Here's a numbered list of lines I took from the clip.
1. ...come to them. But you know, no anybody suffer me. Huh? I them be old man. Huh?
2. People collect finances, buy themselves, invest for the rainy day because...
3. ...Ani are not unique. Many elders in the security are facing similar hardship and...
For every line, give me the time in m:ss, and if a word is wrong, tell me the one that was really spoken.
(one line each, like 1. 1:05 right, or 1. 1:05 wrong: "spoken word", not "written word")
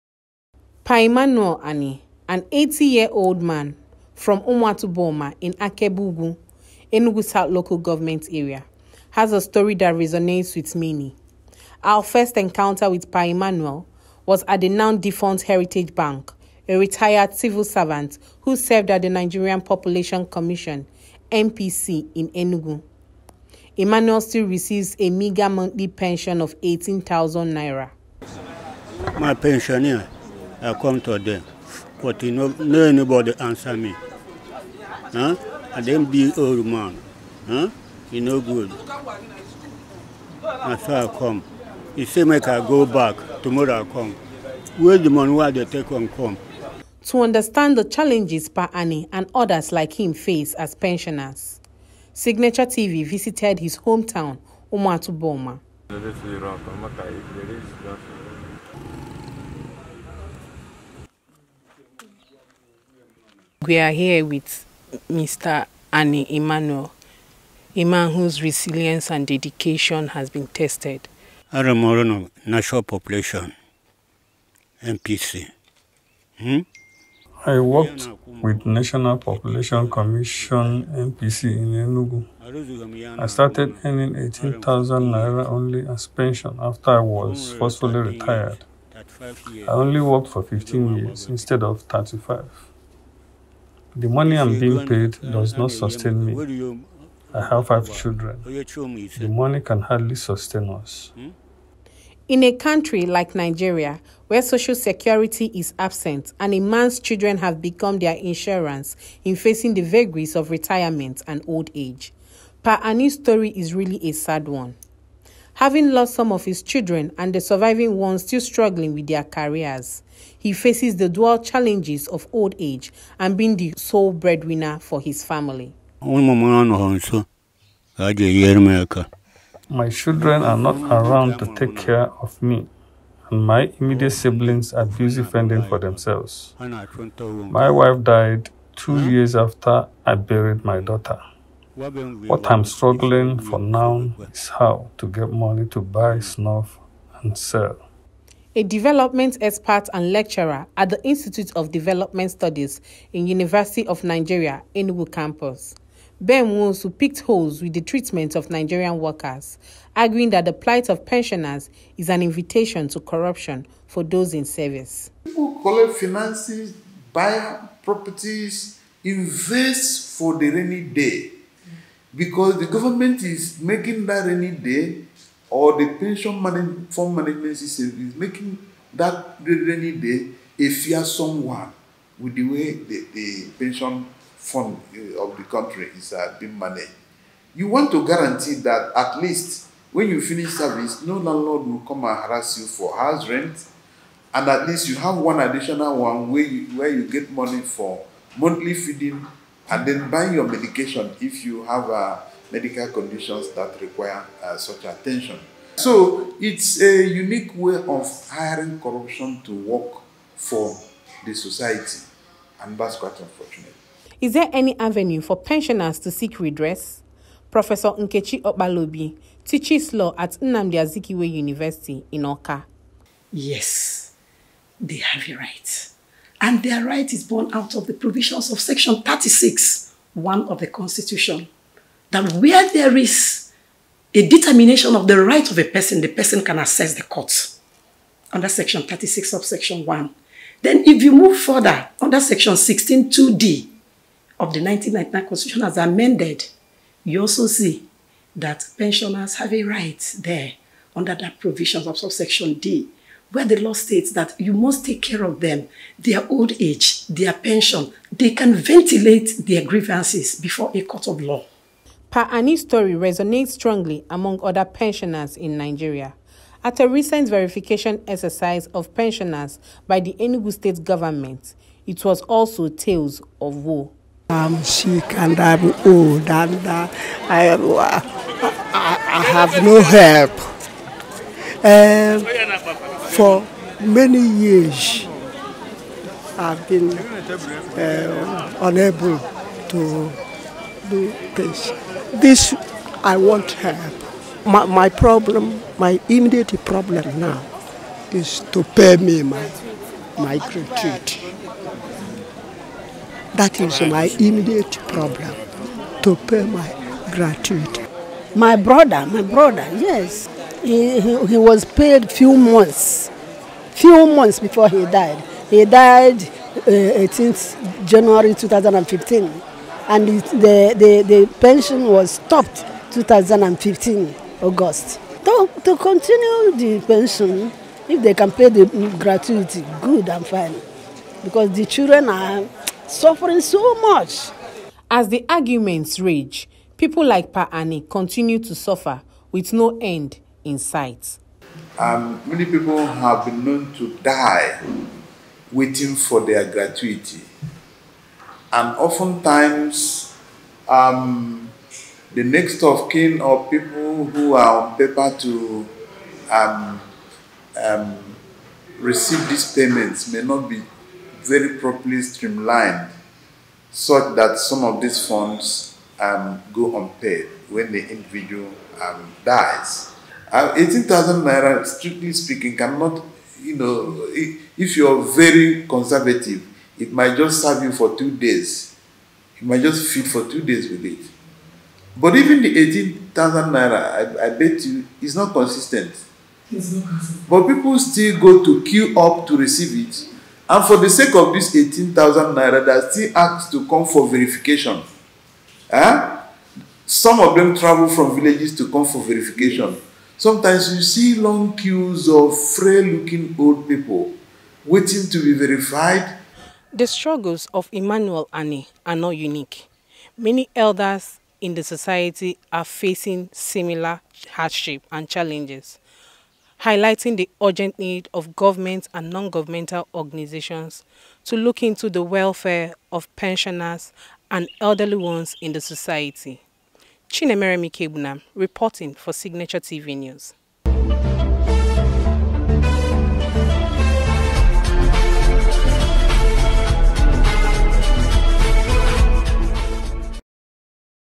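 1. 0:30 wrong: "answer", not "suffer"
2. 2:45 wrong: "properties", not "themselves"
3. 6:48 wrong: "society", not "security".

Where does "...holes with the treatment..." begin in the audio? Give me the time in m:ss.
2:37.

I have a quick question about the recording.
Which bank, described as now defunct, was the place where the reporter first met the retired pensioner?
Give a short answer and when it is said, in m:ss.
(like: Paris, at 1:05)
Heritage Bank, at 0:15.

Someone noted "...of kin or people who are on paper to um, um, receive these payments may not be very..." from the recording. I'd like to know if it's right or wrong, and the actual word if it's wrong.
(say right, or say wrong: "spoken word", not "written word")
right.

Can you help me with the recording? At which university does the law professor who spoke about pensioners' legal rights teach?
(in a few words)
Nnamdi Azikiwe University.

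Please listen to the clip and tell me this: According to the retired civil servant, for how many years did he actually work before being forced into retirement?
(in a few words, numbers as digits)
15.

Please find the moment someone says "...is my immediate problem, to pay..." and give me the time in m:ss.
5:03.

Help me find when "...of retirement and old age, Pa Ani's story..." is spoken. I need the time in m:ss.
1:50.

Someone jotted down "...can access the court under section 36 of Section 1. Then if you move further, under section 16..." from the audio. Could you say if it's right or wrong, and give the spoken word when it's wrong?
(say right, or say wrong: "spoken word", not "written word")
right.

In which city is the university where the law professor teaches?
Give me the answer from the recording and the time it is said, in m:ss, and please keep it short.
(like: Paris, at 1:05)
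Awka, at 3:42.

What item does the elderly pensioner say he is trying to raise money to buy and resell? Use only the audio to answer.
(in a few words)
Snuff.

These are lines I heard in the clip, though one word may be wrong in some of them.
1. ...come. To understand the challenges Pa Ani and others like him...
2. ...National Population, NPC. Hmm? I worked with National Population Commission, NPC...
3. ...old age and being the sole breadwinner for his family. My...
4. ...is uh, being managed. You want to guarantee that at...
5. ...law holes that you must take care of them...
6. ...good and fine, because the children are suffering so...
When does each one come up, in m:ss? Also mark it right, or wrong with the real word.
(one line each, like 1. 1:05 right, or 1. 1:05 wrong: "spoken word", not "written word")
1. 0:46 right
2. 1:12 right
3. 2:02 right
4. 3:05 right
5. 4:13 wrong: "states", not "holes"
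6. 5:29 right.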